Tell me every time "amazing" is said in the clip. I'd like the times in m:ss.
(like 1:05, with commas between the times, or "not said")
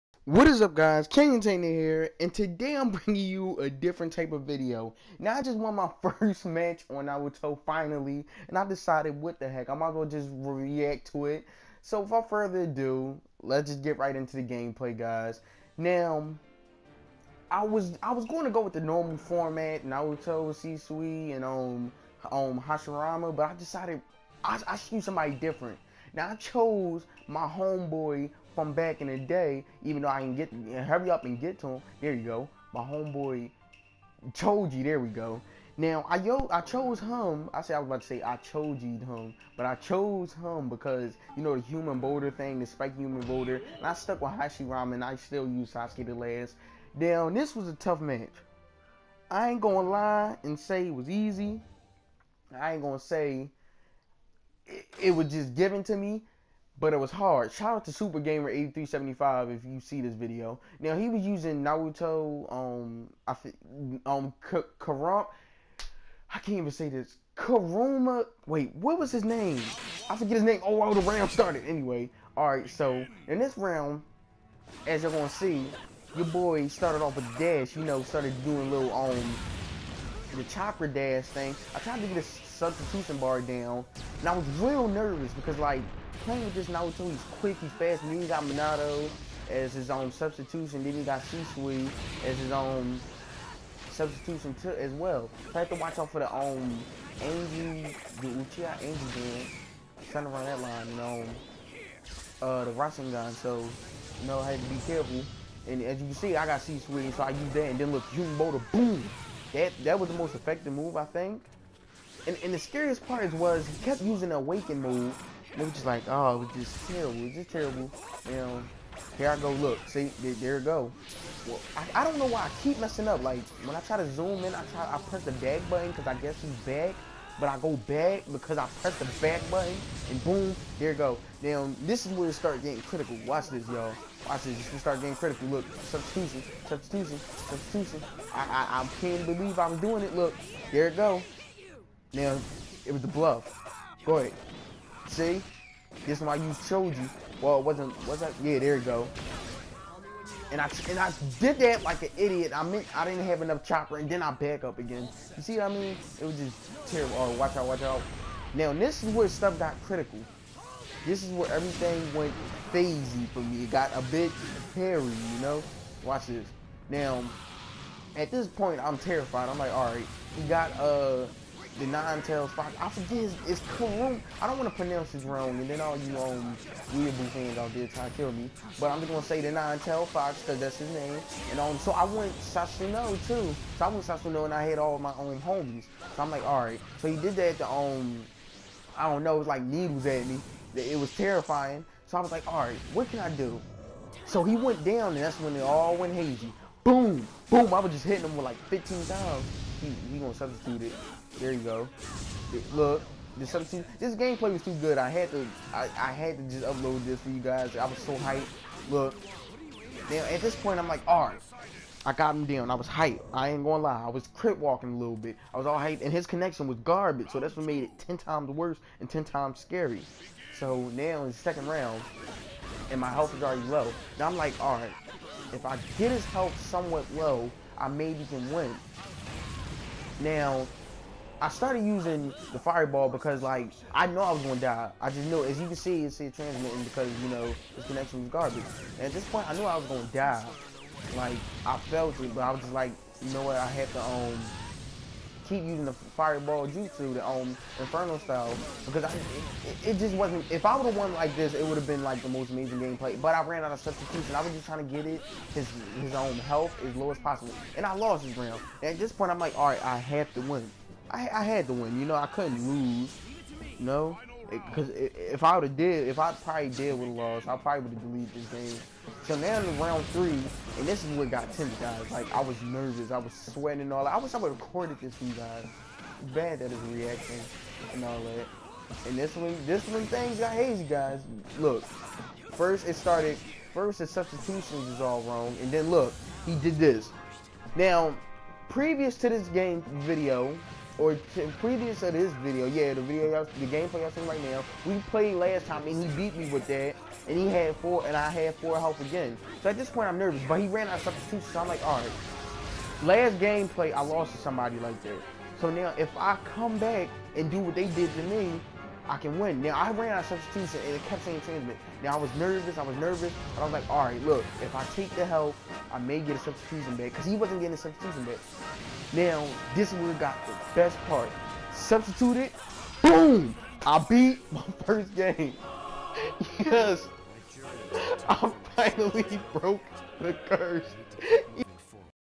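4:12.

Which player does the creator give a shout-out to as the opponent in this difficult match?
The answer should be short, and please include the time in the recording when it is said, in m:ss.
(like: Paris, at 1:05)
Super Gamer 8375, at 0:57.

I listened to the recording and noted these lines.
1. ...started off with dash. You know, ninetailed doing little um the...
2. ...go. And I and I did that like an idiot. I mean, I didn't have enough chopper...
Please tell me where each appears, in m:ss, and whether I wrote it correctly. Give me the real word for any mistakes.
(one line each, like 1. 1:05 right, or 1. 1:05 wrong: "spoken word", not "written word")
1. 1:16 wrong: "started", not "ninetailed"
2. 2:28 right.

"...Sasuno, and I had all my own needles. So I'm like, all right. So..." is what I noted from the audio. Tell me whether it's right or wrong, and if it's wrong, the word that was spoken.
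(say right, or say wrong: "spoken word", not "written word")
wrong: "homies", not "needles".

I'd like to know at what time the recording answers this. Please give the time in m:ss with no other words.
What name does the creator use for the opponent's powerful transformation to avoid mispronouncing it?
2:59.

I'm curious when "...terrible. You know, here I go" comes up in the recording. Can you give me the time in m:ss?
1:57.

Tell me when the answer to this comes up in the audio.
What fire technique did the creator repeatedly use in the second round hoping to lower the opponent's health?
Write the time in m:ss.
4:07.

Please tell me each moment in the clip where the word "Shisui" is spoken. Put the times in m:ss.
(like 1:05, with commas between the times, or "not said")
0:20, 1:31.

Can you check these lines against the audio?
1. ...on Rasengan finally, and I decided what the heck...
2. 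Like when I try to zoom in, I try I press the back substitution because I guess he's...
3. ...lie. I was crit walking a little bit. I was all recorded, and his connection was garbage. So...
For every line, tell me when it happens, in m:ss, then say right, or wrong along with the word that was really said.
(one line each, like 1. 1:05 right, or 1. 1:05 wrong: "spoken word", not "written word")
1. 0:06 wrong: "Naruto", not "Rasengan"
2. 2:03 wrong: "button", not "substitution"
3. 3:33 wrong: "hyped", not "recorded".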